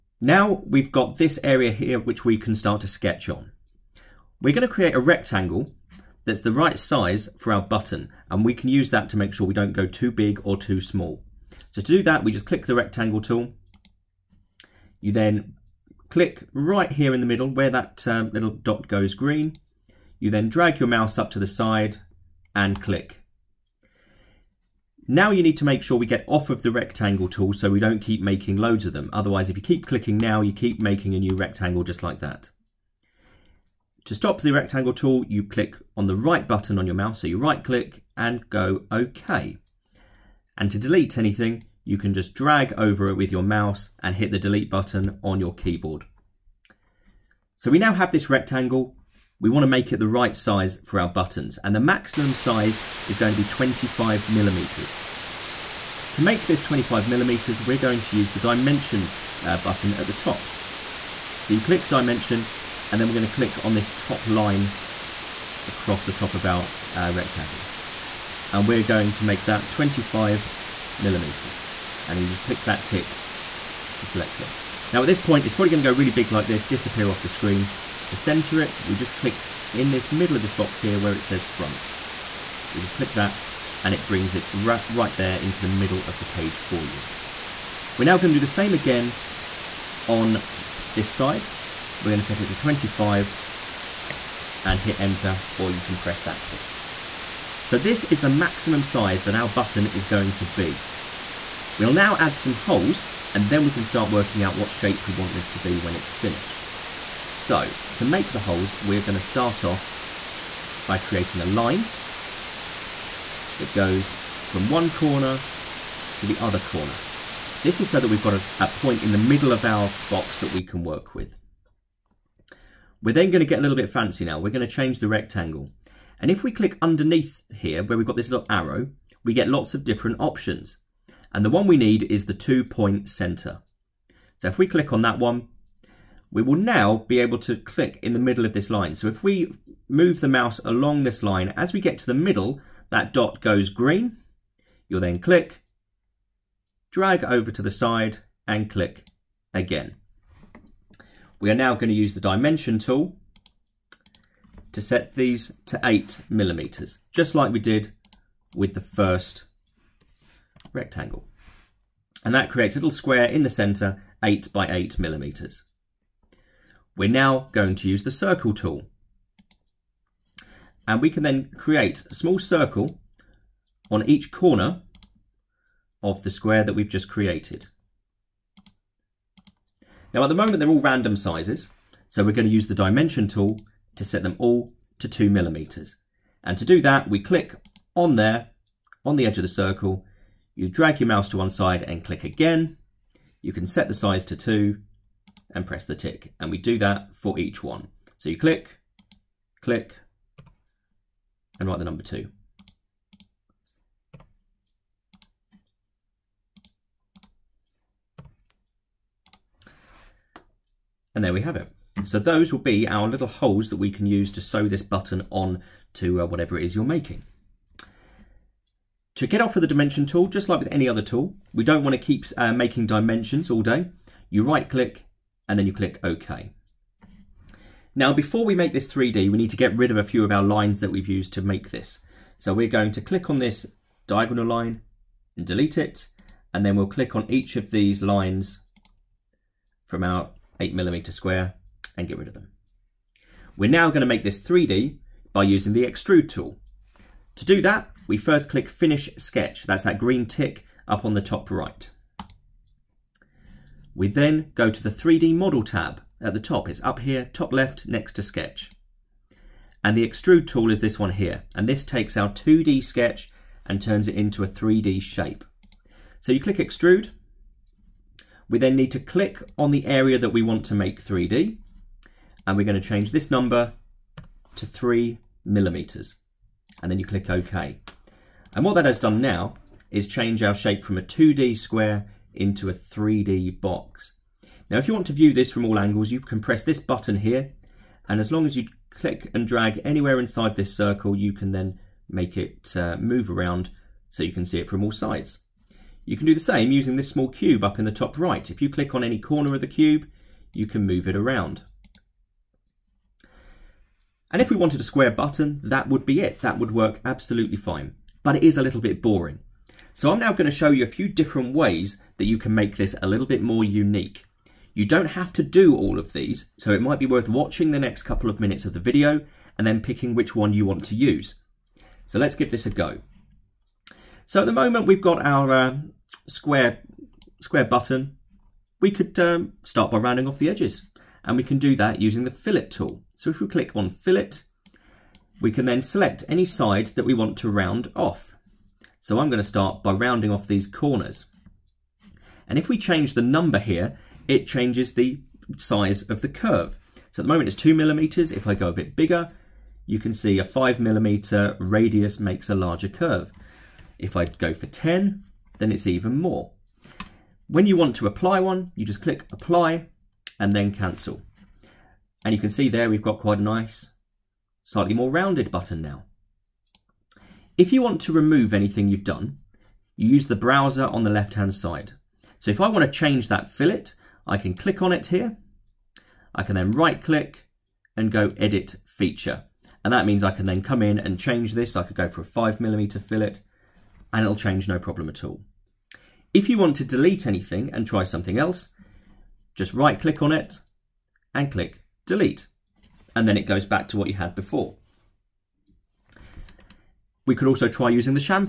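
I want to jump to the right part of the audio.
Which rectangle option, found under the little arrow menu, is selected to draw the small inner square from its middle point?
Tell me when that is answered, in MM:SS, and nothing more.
02:12.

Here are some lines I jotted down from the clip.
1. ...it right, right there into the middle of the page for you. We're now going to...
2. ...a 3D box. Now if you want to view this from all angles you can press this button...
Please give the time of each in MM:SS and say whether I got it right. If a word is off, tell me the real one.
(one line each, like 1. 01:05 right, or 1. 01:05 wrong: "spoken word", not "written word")
1. 01:24 right
2. 04:42 right.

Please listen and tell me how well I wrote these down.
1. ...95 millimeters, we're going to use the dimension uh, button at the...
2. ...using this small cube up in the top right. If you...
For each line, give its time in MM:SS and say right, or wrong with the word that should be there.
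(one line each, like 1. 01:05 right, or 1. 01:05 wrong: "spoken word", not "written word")
1. 00:56 wrong: "25", not "95"
2. 04:56 right.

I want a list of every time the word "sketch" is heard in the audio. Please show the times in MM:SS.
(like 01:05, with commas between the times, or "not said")
00:02, 04:09, 04:18, 04:22.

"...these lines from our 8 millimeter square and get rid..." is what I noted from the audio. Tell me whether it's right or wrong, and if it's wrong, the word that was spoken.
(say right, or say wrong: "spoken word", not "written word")
right.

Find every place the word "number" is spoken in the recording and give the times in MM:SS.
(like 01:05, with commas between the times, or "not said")
03:21, 04:33, 05:43.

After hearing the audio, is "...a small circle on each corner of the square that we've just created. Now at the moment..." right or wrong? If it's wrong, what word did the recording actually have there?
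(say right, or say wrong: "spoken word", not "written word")
right.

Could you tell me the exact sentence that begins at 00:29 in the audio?
Otherwise, if you keep clicking now, you keep making a new rectangle just like that.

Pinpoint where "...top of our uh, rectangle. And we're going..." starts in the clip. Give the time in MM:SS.
01:06.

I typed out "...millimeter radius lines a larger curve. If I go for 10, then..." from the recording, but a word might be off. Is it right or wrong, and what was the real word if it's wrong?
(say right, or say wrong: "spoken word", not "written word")
wrong: "makes", not "lines".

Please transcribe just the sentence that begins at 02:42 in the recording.
And that creates a little square in the center, 8 by 8 millimeters.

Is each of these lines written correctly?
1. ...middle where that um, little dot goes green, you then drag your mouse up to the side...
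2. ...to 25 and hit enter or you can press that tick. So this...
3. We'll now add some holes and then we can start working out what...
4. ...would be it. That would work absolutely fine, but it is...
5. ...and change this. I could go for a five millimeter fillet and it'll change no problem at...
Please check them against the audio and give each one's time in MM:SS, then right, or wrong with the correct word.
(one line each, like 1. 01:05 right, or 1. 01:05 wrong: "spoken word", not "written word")
1. 00:17 right
2. 01:32 right
3. 01:41 right
4. 05:05 right
5. 06:20 right.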